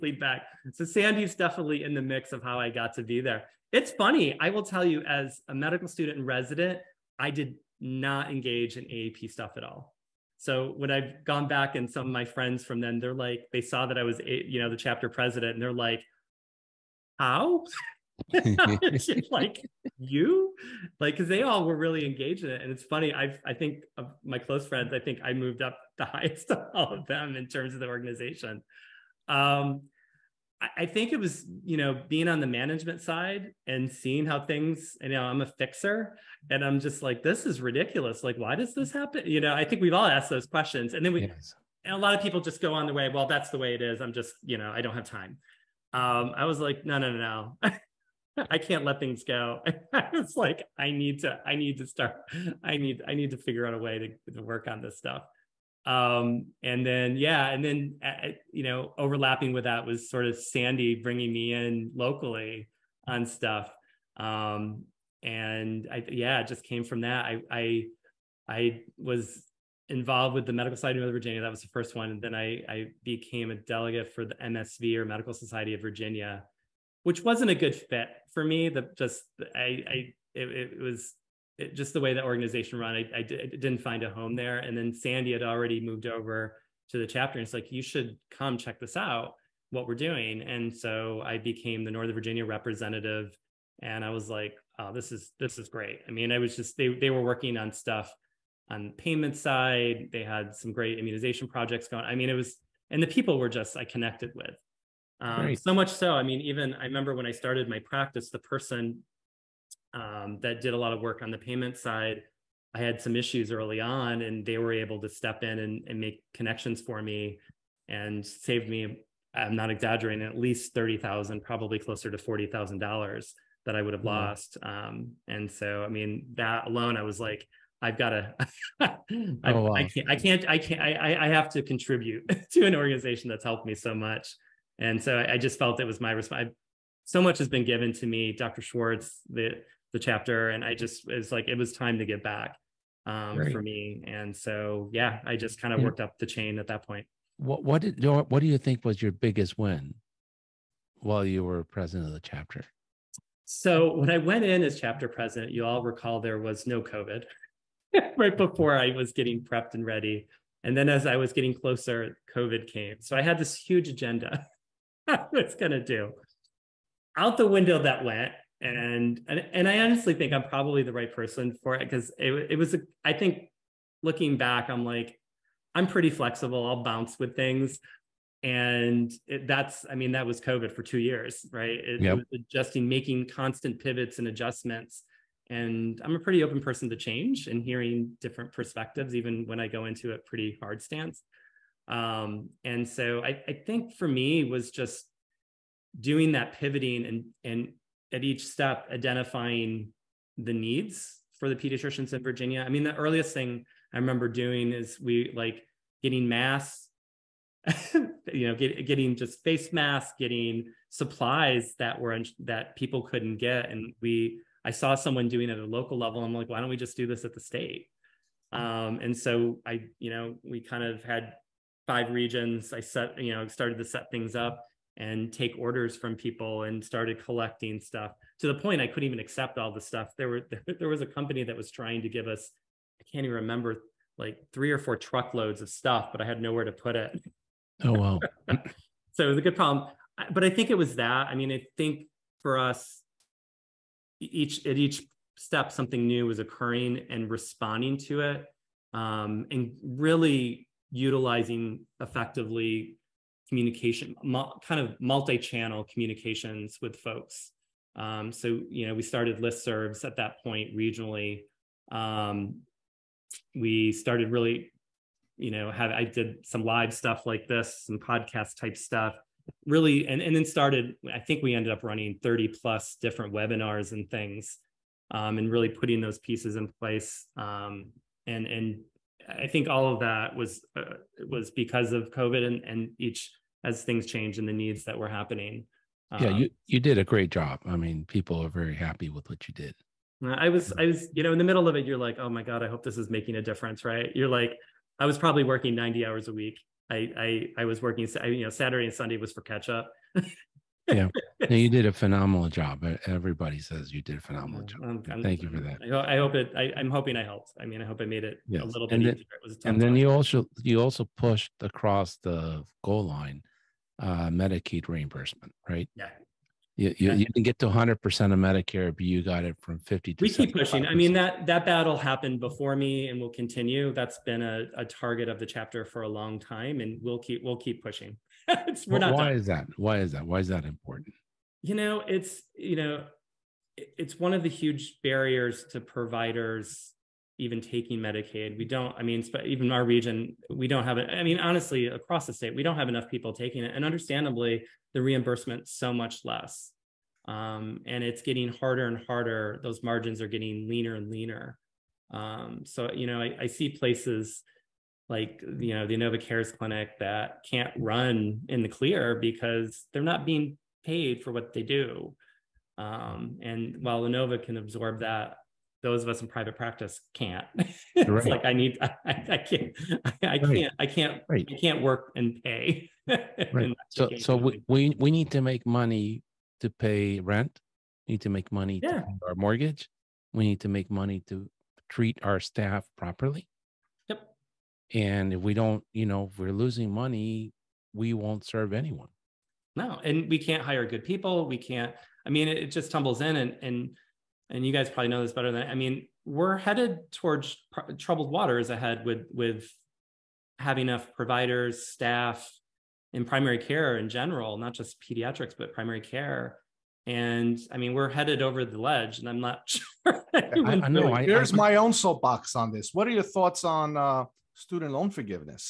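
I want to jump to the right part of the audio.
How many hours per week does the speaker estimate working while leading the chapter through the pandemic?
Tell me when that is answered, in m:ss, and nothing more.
4:55.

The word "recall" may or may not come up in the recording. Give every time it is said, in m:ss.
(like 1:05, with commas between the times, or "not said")
2:35.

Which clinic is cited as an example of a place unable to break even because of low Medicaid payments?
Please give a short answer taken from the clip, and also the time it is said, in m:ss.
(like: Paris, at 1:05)
Inova Cares Clinic, at 5:55.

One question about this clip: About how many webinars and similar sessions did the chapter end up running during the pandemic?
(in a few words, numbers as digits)
30 plus.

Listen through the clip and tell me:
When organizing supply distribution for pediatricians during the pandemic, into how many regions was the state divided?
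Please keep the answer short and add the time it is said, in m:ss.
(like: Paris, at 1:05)
5, at 3:41.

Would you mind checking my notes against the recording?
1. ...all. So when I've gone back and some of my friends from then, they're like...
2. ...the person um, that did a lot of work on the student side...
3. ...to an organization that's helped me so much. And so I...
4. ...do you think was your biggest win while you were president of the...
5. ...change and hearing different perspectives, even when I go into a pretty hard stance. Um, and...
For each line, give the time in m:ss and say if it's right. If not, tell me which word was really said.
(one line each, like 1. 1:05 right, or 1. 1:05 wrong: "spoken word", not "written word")
1. 0:09 right
2. 1:48 wrong: "payment", not "student"
3. 2:12 right
4. 2:28 right
5. 3:06 right.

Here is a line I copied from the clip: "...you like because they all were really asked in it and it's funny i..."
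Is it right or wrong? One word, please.
wrong.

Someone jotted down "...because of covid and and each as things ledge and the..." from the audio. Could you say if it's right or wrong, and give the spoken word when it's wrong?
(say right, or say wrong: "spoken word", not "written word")
wrong: "change", not "ledge".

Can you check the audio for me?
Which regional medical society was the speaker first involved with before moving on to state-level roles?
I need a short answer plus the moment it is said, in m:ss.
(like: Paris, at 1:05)
Medical Society of Northern Virginia, at 1:10.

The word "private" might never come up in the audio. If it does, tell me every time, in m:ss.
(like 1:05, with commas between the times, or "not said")
6:06.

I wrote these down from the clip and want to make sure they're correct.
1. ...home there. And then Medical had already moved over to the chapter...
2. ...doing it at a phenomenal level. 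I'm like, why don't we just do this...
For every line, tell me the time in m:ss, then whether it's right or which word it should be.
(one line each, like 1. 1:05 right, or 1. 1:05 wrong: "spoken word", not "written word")
1. 1:24 wrong: "Sandy", not "Medical"
2. 3:35 wrong: "local", not "phenomenal".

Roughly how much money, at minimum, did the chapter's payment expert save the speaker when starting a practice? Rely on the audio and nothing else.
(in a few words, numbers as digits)
$30,000.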